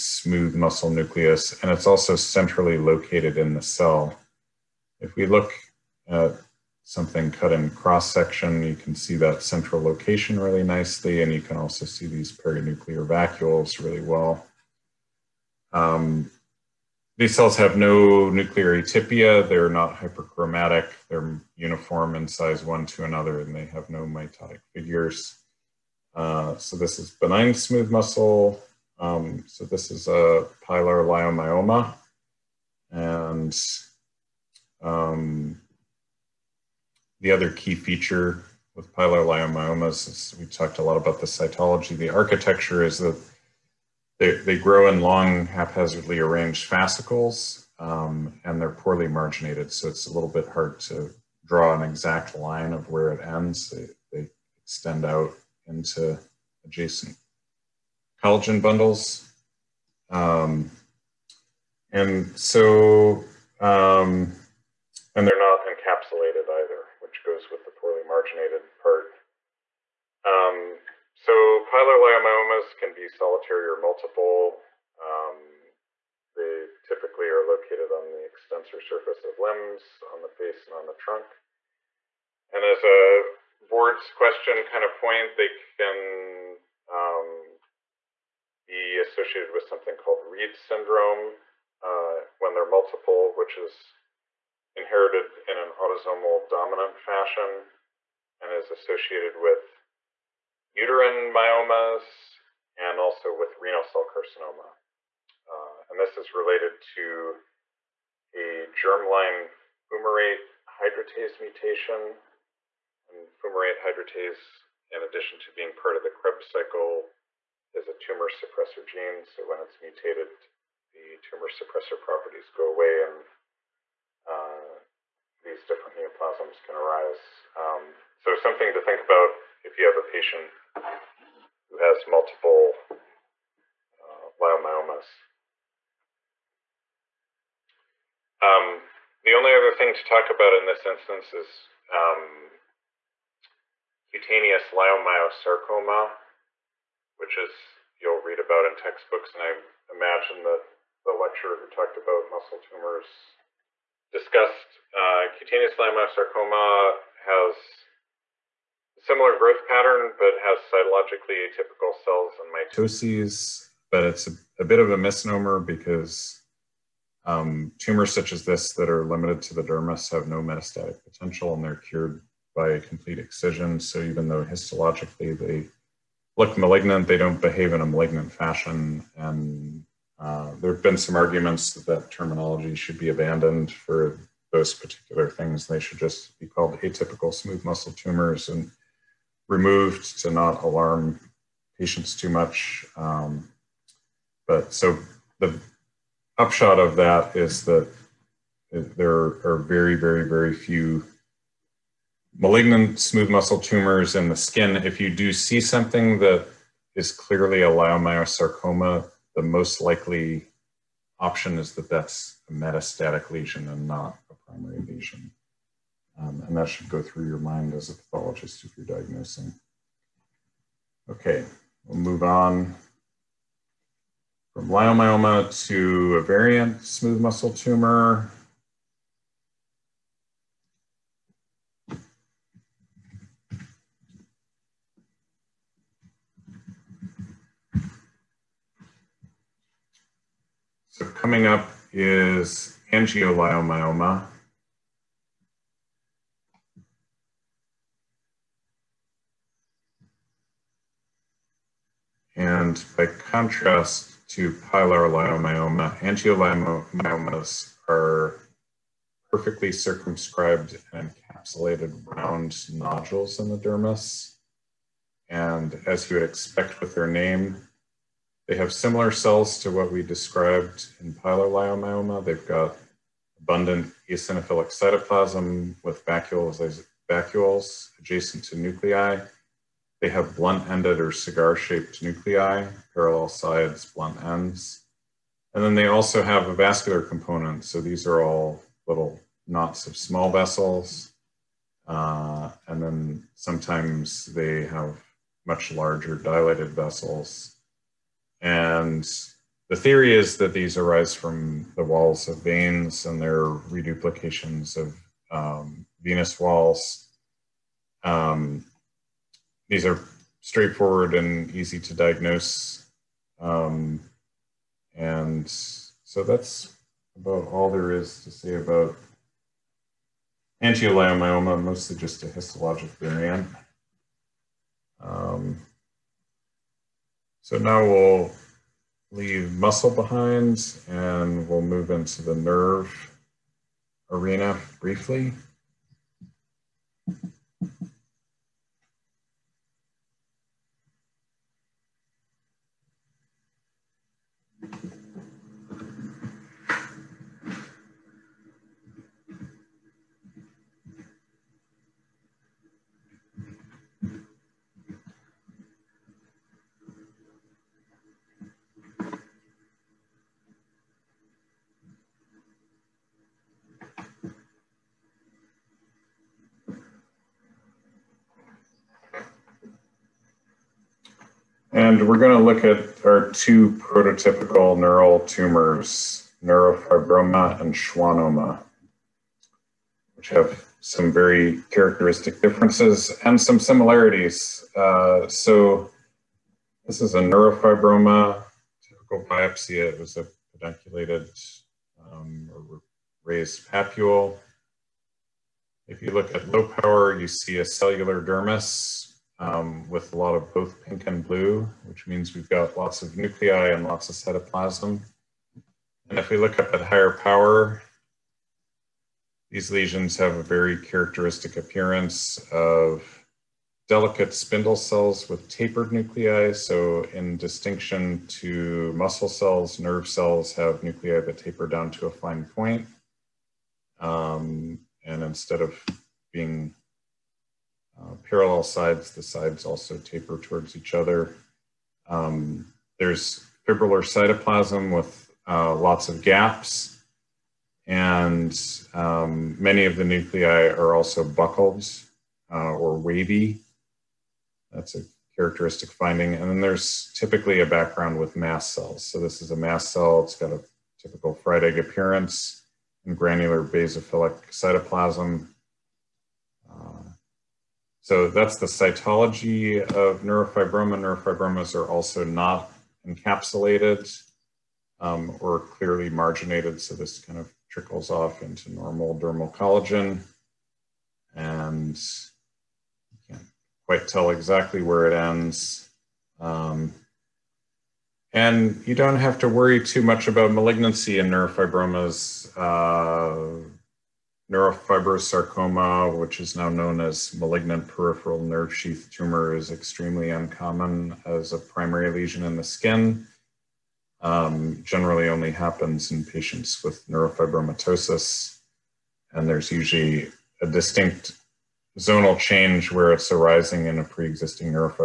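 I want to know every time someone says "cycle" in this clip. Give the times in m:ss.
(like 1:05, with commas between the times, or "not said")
1:56.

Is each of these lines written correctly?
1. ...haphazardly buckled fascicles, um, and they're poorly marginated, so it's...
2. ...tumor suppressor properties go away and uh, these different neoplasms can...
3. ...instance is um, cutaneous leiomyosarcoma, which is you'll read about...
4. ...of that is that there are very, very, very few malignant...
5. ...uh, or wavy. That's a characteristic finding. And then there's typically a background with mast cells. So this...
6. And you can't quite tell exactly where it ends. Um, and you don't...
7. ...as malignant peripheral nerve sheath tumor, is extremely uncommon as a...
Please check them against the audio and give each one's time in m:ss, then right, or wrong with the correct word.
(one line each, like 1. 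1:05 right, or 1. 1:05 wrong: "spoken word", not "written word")
1. 0:45 wrong: "arranged", not "buckled"
2. 2:01 right
3. 2:20 right
4. 3:16 right
5. 7:22 right
6. 7:51 right
7. 8:06 right.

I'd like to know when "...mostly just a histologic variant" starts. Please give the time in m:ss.
5:21.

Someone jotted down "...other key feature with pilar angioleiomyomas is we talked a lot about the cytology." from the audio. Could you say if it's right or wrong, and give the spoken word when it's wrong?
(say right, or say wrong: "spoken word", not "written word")
wrong: "leiomyomas", not "angioleiomyomas".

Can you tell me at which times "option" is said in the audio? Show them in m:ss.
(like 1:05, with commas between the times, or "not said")
3:31.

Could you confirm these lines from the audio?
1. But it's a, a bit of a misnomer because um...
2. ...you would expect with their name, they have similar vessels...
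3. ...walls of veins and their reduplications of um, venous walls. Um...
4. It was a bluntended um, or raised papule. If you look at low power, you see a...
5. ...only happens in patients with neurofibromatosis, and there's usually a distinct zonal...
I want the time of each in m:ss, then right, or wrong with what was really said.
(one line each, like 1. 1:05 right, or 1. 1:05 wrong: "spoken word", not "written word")
1. 2:43 right
2. 4:26 wrong: "cells", not "vessels"
3. 5:01 right
4. 6:29 wrong: "pedunculated", not "bluntended"
5. 8:15 right.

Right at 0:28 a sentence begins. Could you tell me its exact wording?
Um, so this is a pilar leiomyoma.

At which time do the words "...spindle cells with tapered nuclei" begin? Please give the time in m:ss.
6:54.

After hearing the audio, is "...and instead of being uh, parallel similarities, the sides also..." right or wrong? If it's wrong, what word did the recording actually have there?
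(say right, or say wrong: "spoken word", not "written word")
wrong: "sides", not "similarities".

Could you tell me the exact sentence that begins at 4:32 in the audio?
They've got abundant eosinophilic cytoplasm with vacuoles, vacuoles adjacent to nuclei they have blunt-ended or cigar-shaped nuclei, parallel sides, blunt ends.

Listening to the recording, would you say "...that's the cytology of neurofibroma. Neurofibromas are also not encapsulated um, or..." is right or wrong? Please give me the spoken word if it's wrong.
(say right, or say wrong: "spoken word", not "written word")
right.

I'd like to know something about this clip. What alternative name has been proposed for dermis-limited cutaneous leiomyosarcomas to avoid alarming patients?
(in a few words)
Atypical smooth muscle tumors.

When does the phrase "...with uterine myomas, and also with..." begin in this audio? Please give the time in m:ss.
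1:39.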